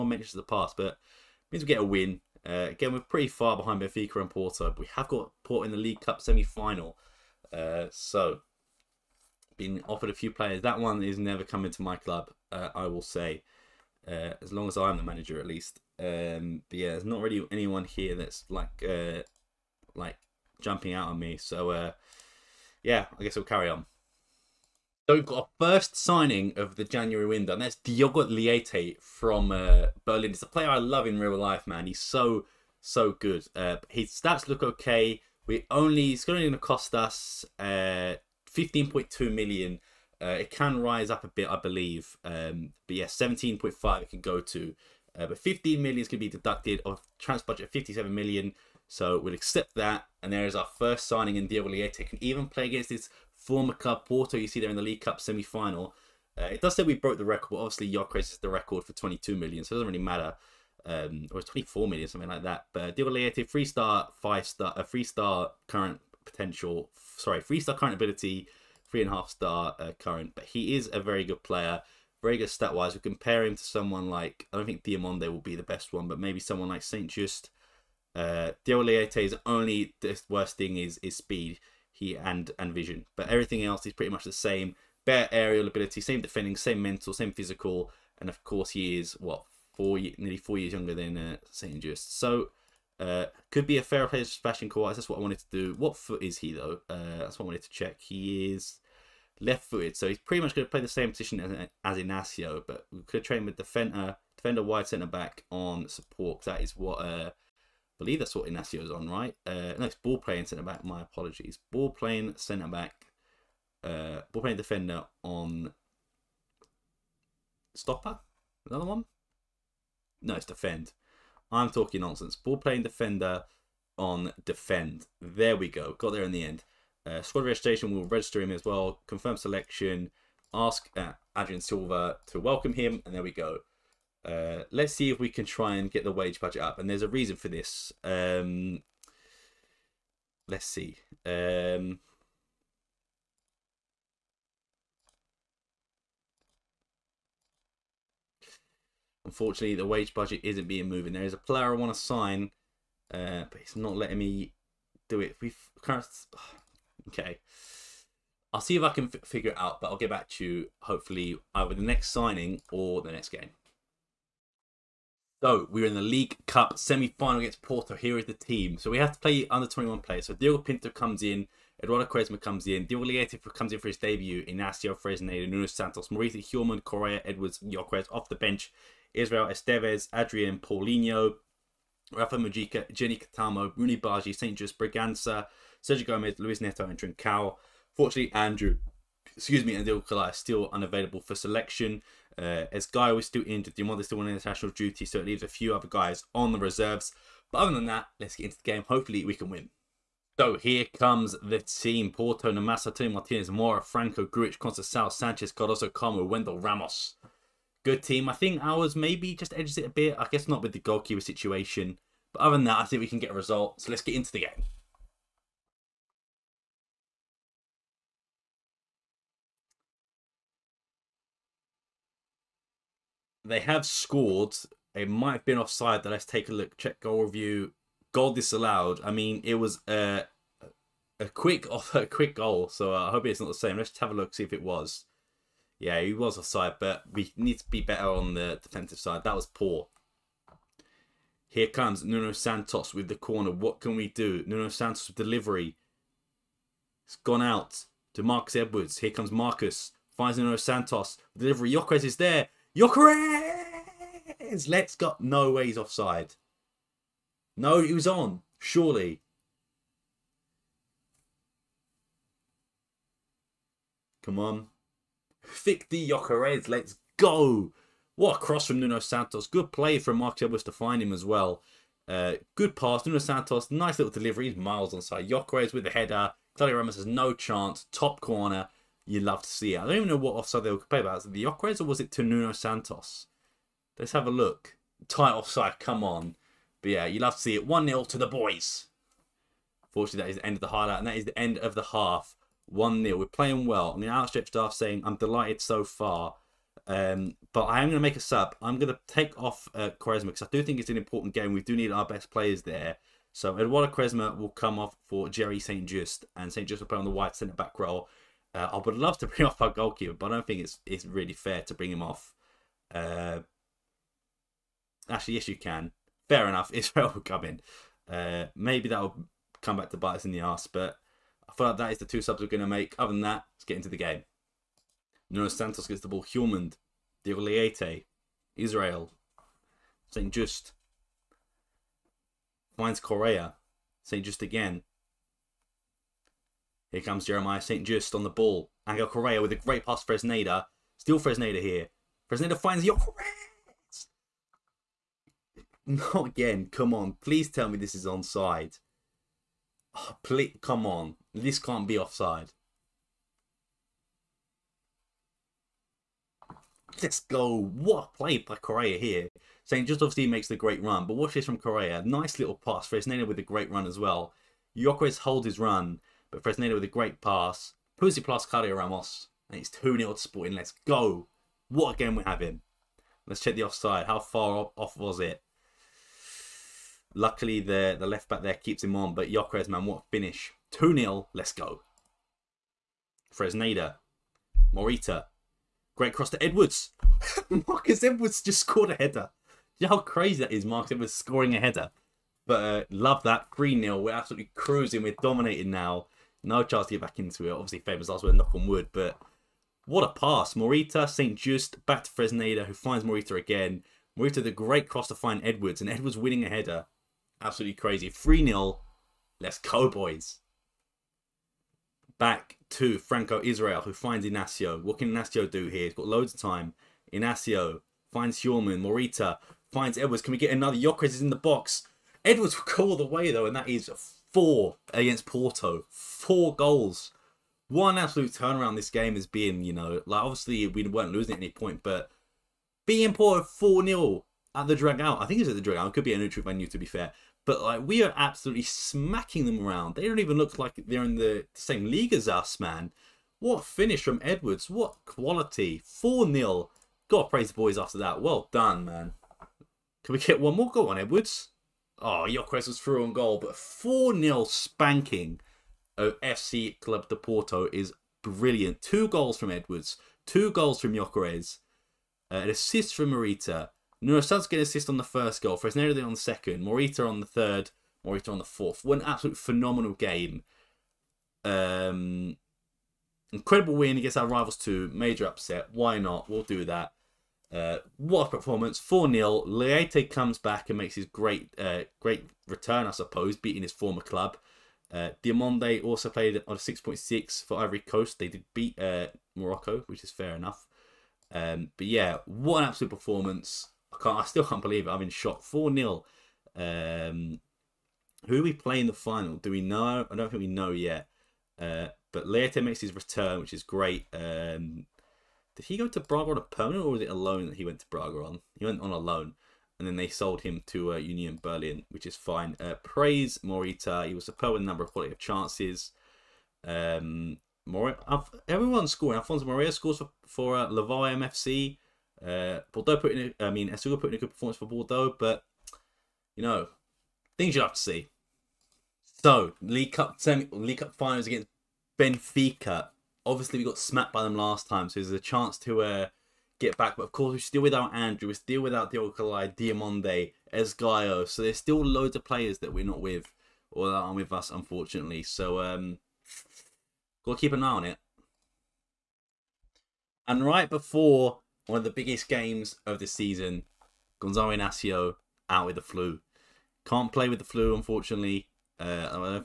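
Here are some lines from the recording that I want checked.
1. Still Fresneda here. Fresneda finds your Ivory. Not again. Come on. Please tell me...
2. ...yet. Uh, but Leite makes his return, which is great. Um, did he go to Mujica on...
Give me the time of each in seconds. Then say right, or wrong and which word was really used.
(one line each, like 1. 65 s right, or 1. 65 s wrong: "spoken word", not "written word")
1. 340 s wrong: "Correa", not "Ivory"
2. 500 s wrong: "Braga", not "Mujica".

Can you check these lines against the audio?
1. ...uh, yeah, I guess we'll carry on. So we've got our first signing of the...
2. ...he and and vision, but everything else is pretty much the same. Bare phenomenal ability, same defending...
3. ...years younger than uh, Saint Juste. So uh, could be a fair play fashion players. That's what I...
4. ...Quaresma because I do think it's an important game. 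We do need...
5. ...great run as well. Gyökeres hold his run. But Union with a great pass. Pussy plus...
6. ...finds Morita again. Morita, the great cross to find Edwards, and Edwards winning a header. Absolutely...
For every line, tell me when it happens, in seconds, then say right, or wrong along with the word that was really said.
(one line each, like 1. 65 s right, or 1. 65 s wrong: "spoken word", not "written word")
1. 21 s right
2. 81 s wrong: "aerial", not "phenomenal"
3. 90 s wrong: "quarters", not "players"
4. 299 s right
5. 363 s wrong: "Fresneda", not "Union"
6. 402 s right.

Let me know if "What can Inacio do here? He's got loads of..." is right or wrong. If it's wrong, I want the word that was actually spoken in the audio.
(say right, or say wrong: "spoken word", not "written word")
right.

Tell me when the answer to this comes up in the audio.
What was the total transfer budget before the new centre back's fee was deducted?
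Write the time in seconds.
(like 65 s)
47 s.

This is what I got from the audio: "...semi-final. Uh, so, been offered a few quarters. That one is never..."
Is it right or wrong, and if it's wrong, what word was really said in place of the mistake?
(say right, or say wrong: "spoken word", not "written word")
wrong: "players", not "quarters".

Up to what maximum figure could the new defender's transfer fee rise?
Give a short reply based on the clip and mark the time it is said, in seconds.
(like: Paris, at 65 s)
17.5 million, at 43 s.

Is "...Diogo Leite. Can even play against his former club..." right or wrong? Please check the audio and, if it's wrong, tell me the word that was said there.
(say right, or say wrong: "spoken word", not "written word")
right.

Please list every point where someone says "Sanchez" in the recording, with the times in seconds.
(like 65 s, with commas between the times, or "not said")
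205 s.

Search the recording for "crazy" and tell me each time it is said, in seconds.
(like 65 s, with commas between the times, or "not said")
390 s, 407 s.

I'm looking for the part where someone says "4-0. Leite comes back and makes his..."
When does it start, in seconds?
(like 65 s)
478 s.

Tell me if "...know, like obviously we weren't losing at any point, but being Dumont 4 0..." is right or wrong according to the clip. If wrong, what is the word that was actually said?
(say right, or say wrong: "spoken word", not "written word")
wrong: "Porto", not "Dumont".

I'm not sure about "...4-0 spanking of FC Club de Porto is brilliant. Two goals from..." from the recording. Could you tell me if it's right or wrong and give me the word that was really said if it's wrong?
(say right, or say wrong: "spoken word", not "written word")
right.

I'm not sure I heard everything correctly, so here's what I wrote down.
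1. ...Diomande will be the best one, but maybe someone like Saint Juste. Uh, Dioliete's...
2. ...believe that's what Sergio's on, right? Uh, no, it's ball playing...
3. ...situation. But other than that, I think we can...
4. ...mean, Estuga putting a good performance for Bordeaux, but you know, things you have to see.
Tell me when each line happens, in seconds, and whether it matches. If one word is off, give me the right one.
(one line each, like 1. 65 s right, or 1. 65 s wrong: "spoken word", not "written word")
1. 74 s right
2. 107 s wrong: "Inacio", not "Sergio"
3. 211 s right
4. 523 s right.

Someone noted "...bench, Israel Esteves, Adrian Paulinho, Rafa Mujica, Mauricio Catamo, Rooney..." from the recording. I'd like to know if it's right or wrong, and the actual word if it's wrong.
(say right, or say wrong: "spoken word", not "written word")
wrong: "Geny", not "Mauricio".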